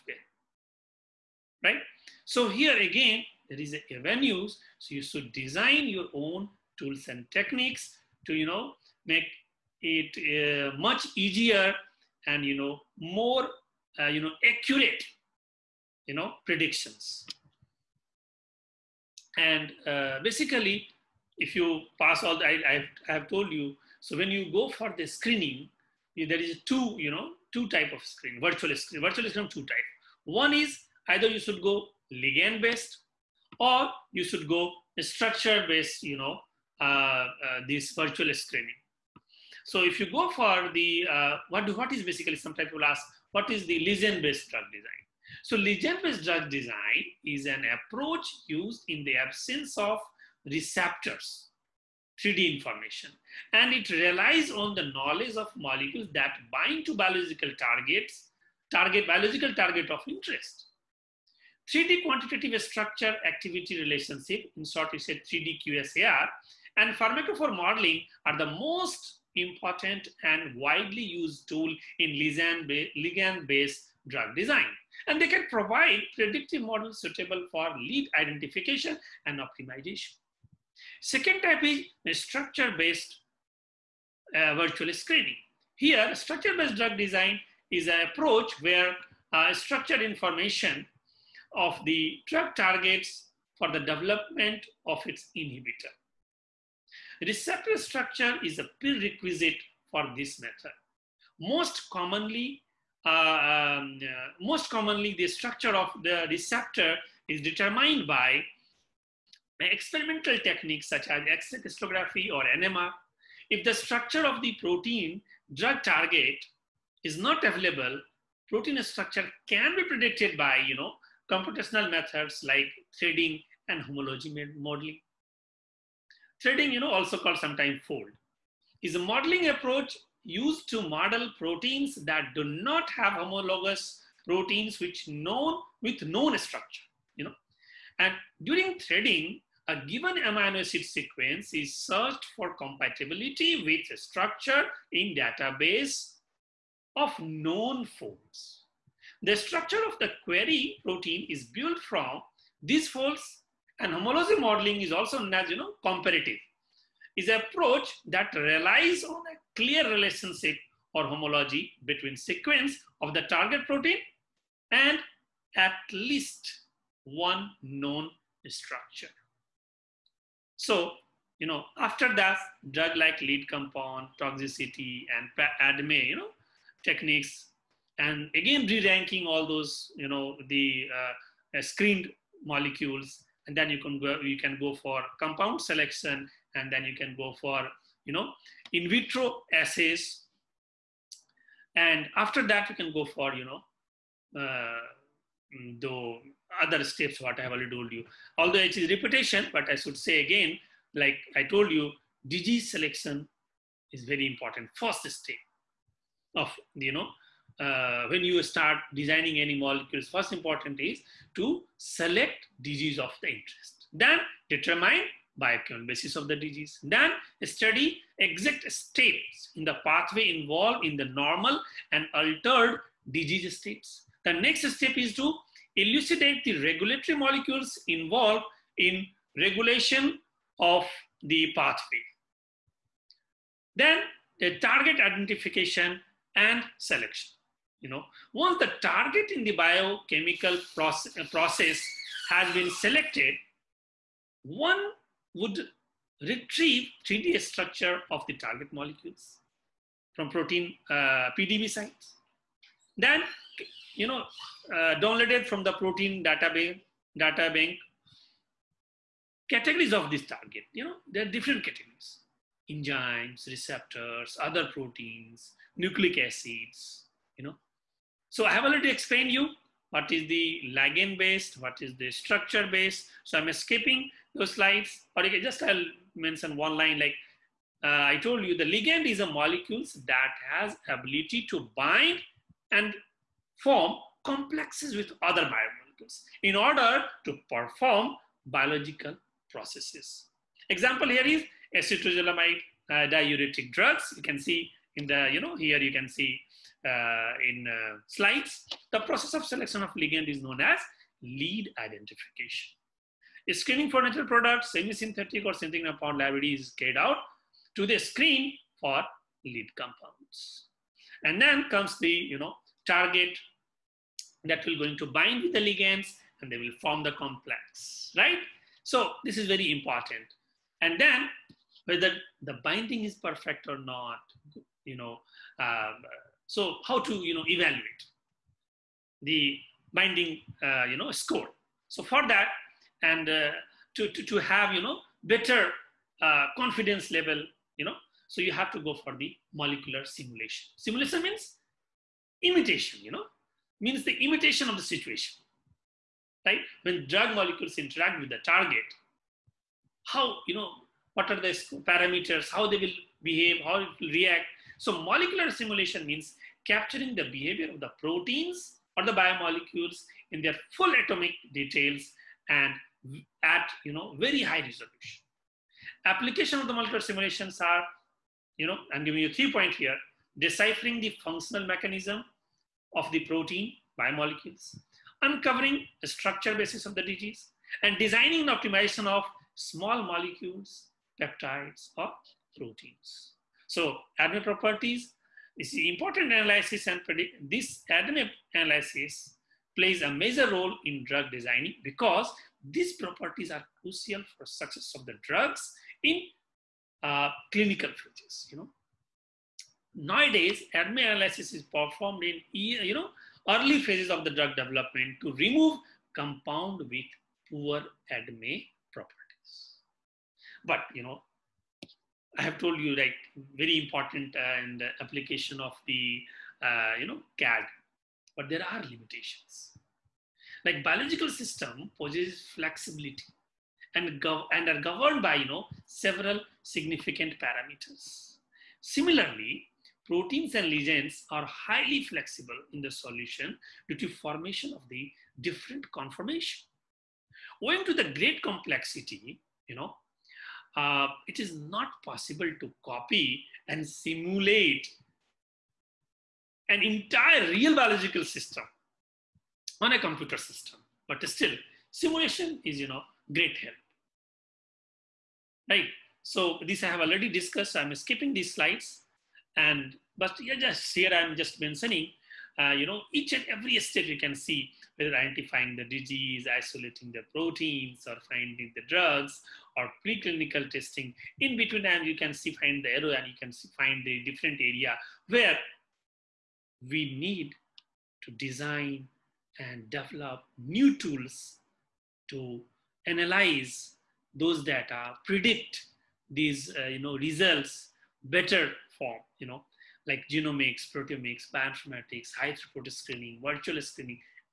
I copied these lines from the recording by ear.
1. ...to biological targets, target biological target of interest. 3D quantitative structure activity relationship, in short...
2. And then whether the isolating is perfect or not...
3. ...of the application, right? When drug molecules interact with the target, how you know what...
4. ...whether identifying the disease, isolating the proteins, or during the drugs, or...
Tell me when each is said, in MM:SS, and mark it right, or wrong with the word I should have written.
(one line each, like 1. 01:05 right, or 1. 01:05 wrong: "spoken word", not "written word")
1. 00:56 right
2. 05:20 wrong: "binding", not "isolating"
3. 05:44 wrong: "situation", not "application"
4. 07:44 wrong: "finding", not "during".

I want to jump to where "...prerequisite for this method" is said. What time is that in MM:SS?
01:38.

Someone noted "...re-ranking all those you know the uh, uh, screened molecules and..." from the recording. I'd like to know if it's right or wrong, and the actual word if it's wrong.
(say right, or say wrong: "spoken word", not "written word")
right.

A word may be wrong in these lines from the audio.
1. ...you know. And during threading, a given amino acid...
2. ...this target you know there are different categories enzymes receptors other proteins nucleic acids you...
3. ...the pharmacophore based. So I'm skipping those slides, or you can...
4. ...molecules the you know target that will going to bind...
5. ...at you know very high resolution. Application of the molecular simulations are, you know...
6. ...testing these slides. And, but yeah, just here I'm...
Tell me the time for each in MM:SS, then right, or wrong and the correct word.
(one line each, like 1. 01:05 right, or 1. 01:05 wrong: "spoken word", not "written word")
1. 02:17 right
2. 04:20 right
3. 04:31 wrong: "structure", not "pharmacophore"
4. 05:11 wrong: "comes", not "molecules"
5. 06:03 right
6. 07:37 wrong: "skipping", not "testing".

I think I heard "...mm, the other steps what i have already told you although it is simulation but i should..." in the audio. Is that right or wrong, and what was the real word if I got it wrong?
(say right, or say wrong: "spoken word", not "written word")
wrong: "repetition", not "simulation".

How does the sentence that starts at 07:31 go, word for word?
But still, simulation is, you know, great help.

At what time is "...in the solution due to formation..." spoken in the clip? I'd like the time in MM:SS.
07:12.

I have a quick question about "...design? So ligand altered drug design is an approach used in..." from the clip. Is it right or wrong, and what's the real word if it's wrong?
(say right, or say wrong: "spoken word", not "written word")
wrong: "based", not "altered".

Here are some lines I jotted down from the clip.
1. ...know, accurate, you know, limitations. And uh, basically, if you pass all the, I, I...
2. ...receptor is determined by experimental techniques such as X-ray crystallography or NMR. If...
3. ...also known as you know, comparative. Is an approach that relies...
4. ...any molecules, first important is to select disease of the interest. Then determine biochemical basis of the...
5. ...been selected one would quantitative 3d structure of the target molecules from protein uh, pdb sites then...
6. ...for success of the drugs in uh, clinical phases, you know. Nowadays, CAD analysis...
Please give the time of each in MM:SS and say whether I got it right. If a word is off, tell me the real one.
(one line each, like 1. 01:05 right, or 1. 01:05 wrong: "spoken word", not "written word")
1. 00:14 wrong: "predictions", not "limitations"
2. 01:46 right
3. 02:34 right
4. 03:29 right
5. 04:02 wrong: "retrieve", not "quantitative"
6. 06:34 wrong: "ADME", not "CAD".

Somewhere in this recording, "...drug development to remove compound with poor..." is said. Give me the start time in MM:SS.
06:44.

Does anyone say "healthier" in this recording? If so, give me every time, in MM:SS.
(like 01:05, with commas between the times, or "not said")
not said.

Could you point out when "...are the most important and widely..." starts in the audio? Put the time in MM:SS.
01:08.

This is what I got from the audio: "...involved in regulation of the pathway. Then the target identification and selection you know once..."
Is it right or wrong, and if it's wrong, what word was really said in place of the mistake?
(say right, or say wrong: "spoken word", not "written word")
right.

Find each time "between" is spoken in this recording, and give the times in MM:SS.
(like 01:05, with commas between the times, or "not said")
02:41, 07:51.